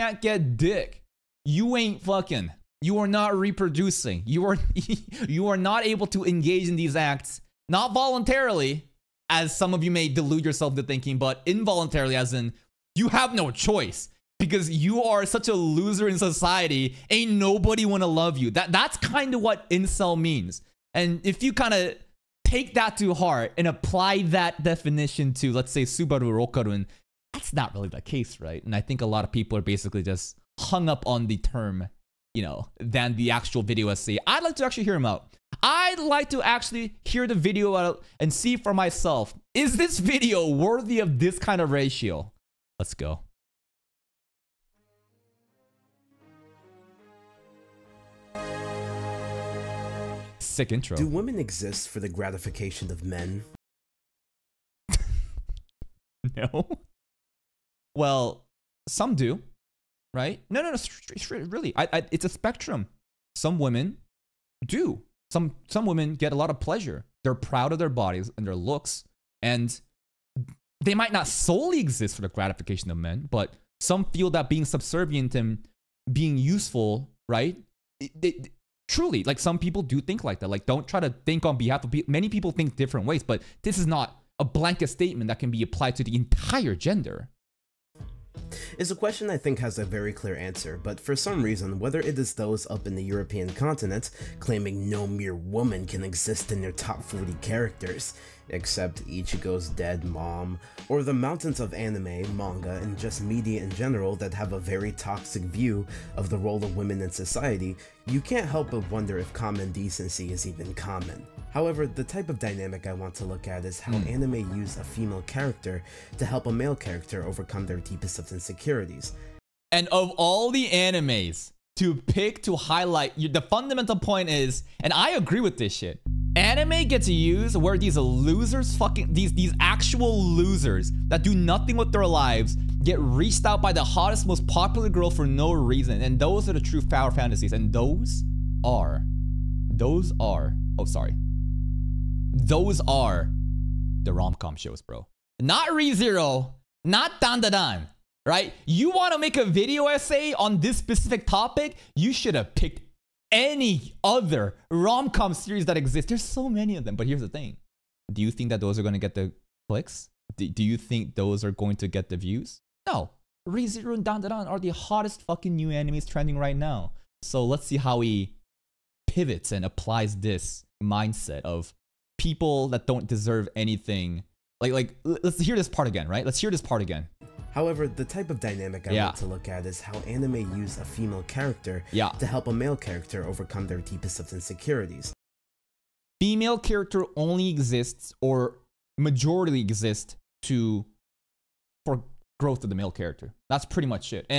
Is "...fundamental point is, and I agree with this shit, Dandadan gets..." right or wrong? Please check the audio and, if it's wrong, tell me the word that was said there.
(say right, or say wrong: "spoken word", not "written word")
wrong: "Anime", not "Dandadan".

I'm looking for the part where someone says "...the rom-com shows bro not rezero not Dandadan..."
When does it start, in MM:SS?
02:24.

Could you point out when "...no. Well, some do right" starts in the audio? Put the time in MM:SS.
00:56.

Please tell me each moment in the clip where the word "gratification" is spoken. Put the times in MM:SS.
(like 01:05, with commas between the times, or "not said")
00:52, 01:12.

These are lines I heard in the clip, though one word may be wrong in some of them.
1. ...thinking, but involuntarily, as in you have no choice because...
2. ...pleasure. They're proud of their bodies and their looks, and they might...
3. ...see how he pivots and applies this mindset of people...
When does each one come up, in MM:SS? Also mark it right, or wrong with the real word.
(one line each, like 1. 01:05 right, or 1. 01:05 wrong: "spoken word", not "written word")
1. 00:10 right
2. 01:06 right
3. 02:47 right.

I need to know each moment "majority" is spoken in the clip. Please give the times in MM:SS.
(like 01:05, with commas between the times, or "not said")
03:08.